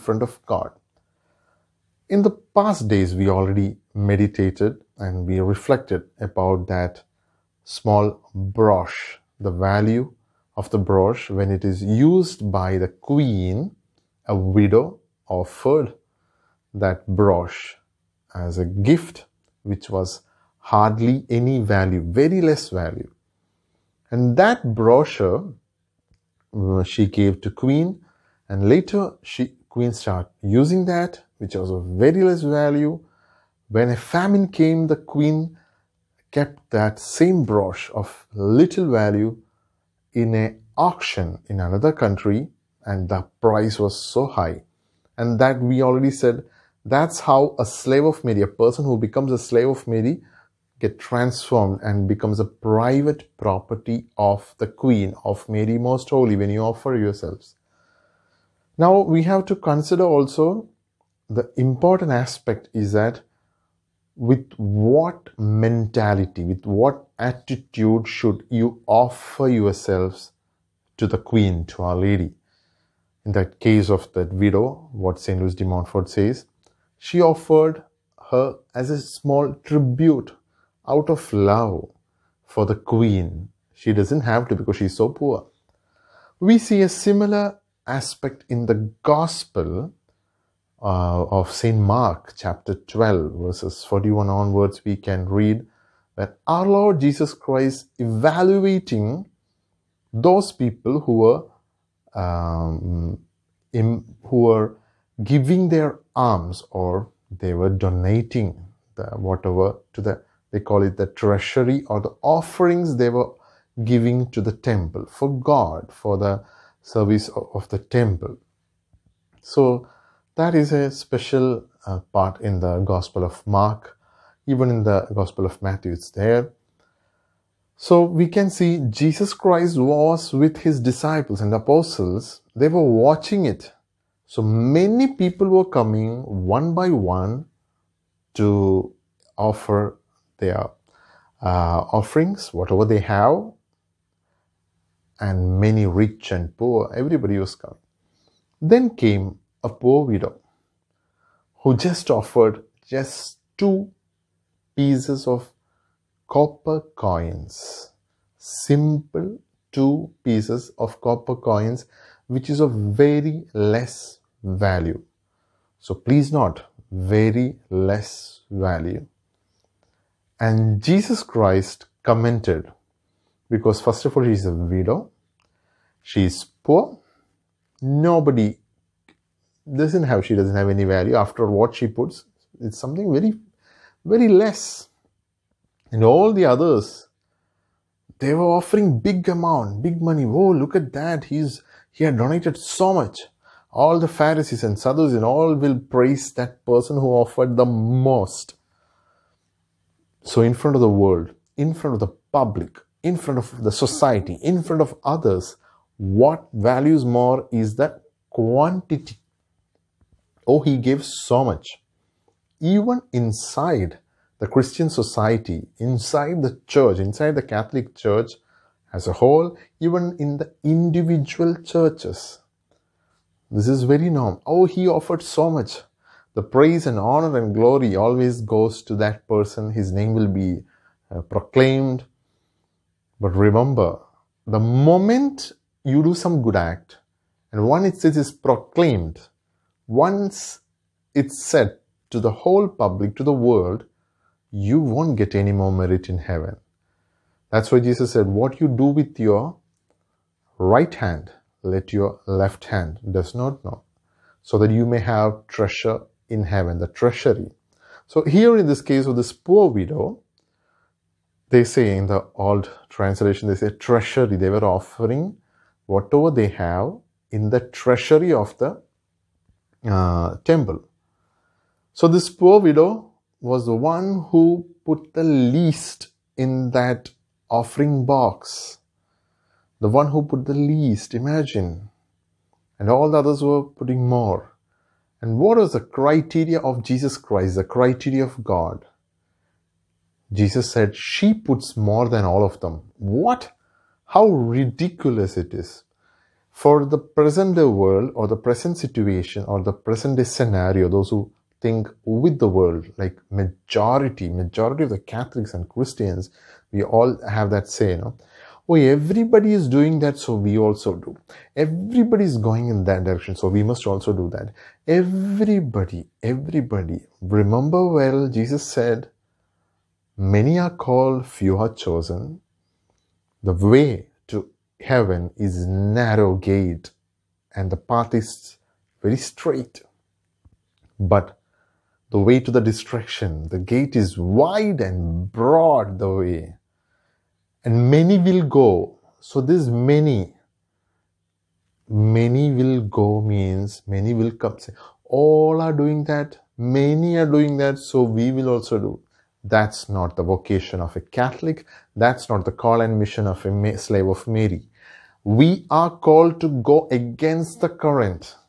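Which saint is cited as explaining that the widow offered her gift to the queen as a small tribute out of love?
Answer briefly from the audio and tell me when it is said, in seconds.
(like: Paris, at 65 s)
St. Louis de Montfort, at 75 s.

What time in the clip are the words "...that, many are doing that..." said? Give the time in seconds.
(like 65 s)
346 s.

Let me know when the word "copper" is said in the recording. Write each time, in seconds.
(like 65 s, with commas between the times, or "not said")
156 s, 161 s.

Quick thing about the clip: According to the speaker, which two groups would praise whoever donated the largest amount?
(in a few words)
Pharisees and Sadducees.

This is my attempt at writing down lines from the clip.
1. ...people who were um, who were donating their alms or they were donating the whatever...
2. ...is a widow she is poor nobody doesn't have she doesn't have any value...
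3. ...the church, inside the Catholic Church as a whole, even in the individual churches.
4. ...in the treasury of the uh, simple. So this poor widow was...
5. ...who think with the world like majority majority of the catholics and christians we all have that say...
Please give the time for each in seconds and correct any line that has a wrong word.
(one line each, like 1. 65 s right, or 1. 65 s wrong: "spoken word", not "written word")
1. 100 s wrong: "giving", not "donating"
2. 174 s right
3. 216 s right
4. 267 s wrong: "temple", not "simple"
5. 301 s right.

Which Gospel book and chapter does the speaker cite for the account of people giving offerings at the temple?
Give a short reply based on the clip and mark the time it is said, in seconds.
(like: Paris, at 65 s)
St. Mark, chapter 12, at 91 s.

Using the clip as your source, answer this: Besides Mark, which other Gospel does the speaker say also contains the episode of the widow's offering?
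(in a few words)
Matthew.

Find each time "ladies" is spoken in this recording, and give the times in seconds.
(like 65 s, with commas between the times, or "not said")
not said.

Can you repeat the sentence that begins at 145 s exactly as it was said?
And many rich and poor, everybody was coming.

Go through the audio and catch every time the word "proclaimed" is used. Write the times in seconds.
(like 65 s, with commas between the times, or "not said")
231 s, 238 s.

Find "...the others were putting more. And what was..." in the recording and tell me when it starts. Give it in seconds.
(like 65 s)
283 s.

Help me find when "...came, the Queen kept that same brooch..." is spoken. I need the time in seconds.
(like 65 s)
34 s.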